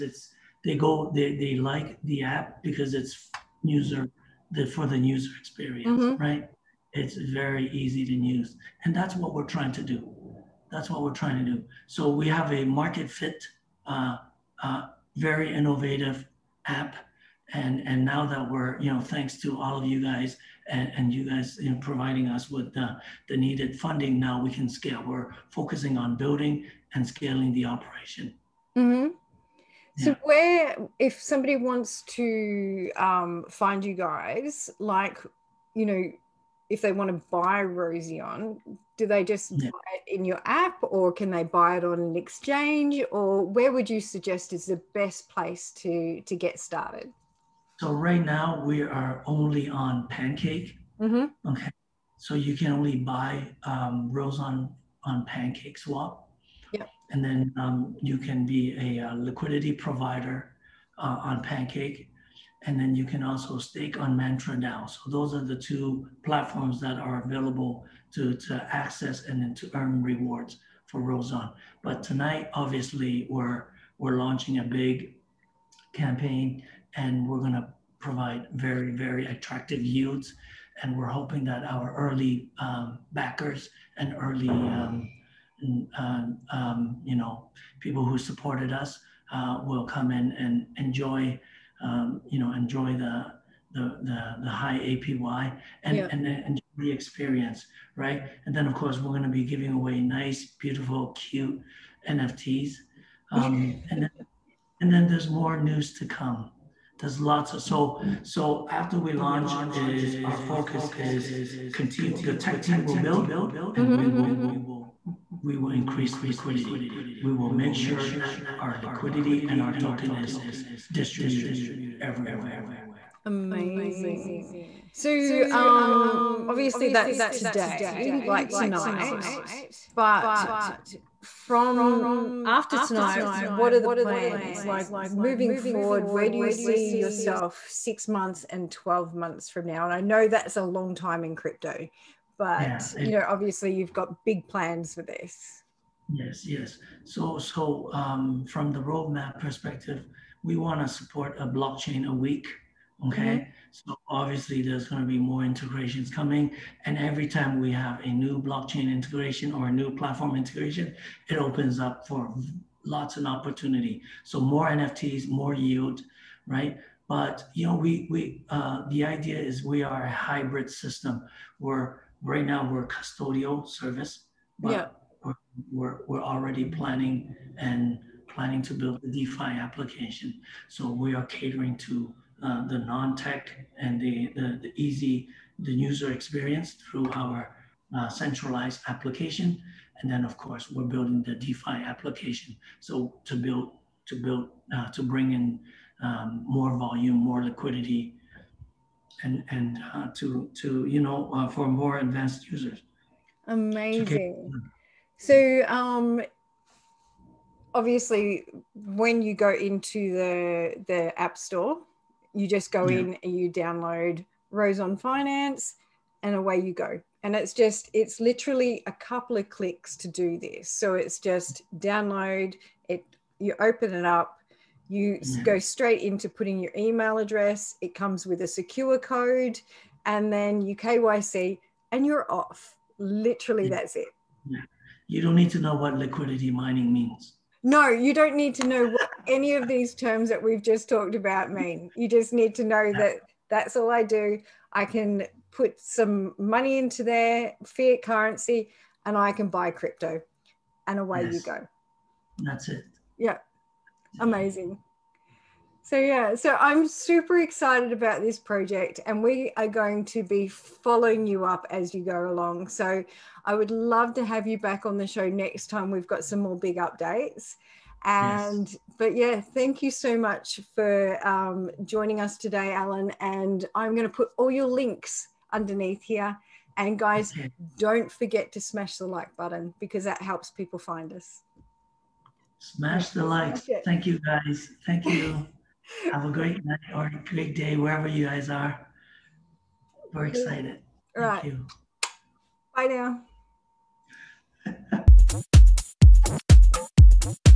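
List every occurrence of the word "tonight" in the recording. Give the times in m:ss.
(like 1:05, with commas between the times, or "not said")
1:12, 2:08, 2:12.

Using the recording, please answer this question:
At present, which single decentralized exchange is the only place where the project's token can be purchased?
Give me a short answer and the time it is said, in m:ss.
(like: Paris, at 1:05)
PancakeSwap, at 0:55.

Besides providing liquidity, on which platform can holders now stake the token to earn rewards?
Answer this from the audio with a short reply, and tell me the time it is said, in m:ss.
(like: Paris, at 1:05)
Mantra, at 1:04.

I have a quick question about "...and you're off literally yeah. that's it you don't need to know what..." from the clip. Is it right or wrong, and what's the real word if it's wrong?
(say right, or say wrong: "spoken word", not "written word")
right.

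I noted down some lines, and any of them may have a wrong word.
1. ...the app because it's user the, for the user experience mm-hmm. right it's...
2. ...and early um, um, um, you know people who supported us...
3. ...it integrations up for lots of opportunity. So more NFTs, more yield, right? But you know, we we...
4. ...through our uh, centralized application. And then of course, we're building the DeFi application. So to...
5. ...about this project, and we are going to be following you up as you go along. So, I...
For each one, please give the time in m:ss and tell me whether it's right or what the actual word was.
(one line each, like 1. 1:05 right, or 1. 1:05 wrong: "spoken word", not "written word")
1. 0:02 right
2. 1:23 right
3. 2:41 wrong: "opens", not "integrations"
4. 3:06 right
5. 4:17 right.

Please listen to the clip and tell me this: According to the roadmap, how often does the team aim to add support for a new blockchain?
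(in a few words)
a week.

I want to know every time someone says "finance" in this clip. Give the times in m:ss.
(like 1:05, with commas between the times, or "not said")
3:34.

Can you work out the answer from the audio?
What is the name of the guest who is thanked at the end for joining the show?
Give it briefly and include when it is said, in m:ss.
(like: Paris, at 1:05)
Allan, at 4:32.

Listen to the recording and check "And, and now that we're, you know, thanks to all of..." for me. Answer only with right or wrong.
right.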